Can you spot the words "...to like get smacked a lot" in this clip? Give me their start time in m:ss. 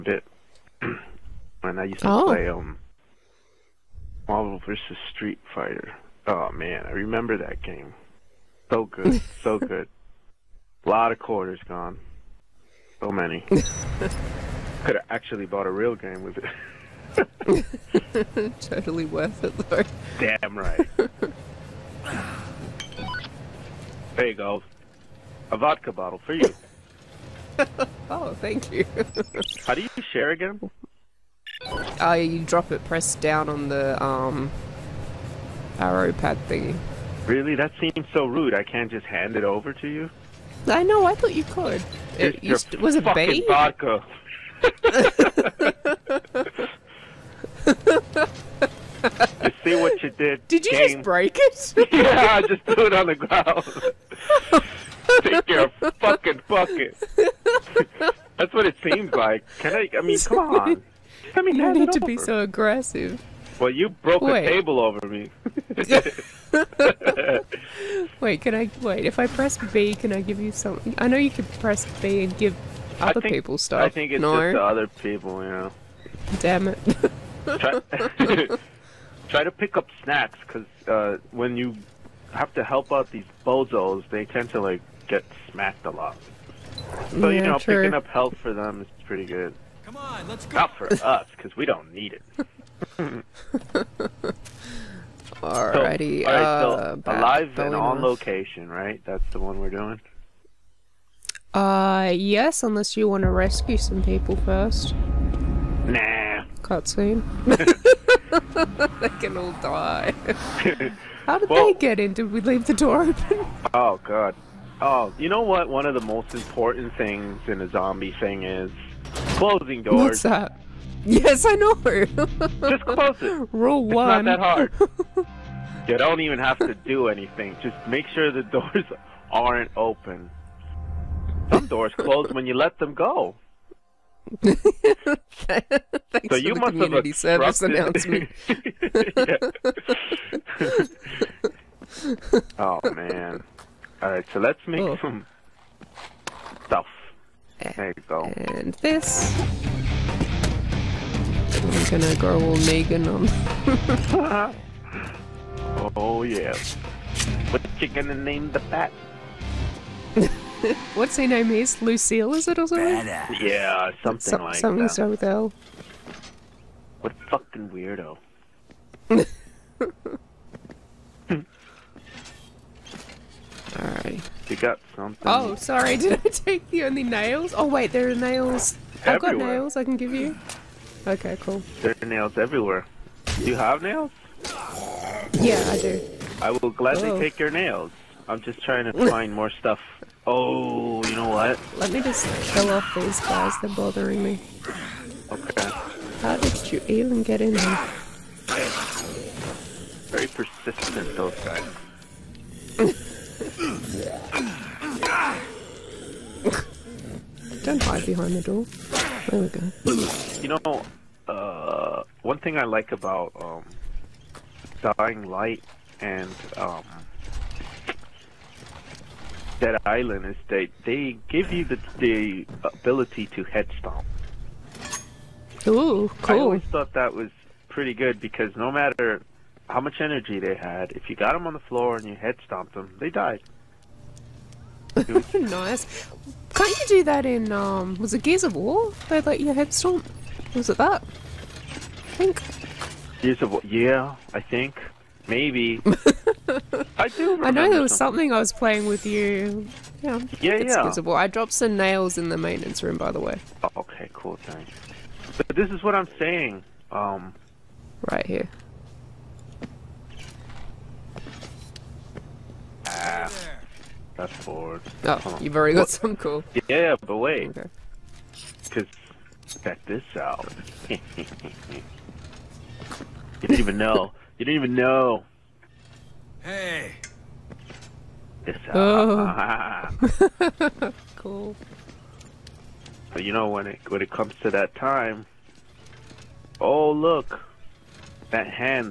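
1:24.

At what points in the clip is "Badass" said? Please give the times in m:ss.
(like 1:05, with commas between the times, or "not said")
2:42.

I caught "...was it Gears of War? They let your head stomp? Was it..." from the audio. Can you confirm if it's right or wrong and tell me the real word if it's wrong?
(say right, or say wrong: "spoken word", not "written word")
right.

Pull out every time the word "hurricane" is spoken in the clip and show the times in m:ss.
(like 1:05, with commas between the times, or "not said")
not said.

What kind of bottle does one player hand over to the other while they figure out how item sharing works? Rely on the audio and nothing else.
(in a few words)
vodka bottle.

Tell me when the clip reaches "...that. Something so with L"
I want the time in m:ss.
2:44.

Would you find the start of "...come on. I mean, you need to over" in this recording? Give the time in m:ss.
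1:00.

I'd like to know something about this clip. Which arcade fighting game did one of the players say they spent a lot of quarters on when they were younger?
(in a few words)
Marvel vs. Street Fighter.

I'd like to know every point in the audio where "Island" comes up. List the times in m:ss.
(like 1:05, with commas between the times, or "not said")
3:39.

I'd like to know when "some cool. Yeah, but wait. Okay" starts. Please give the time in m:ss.
4:25.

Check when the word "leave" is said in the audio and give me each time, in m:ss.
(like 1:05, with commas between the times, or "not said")
1:52.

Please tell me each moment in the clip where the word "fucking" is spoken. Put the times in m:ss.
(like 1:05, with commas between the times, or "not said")
0:56, 2:47.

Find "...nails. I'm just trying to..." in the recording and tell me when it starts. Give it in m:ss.
3:07.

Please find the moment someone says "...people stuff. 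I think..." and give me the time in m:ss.
1:13.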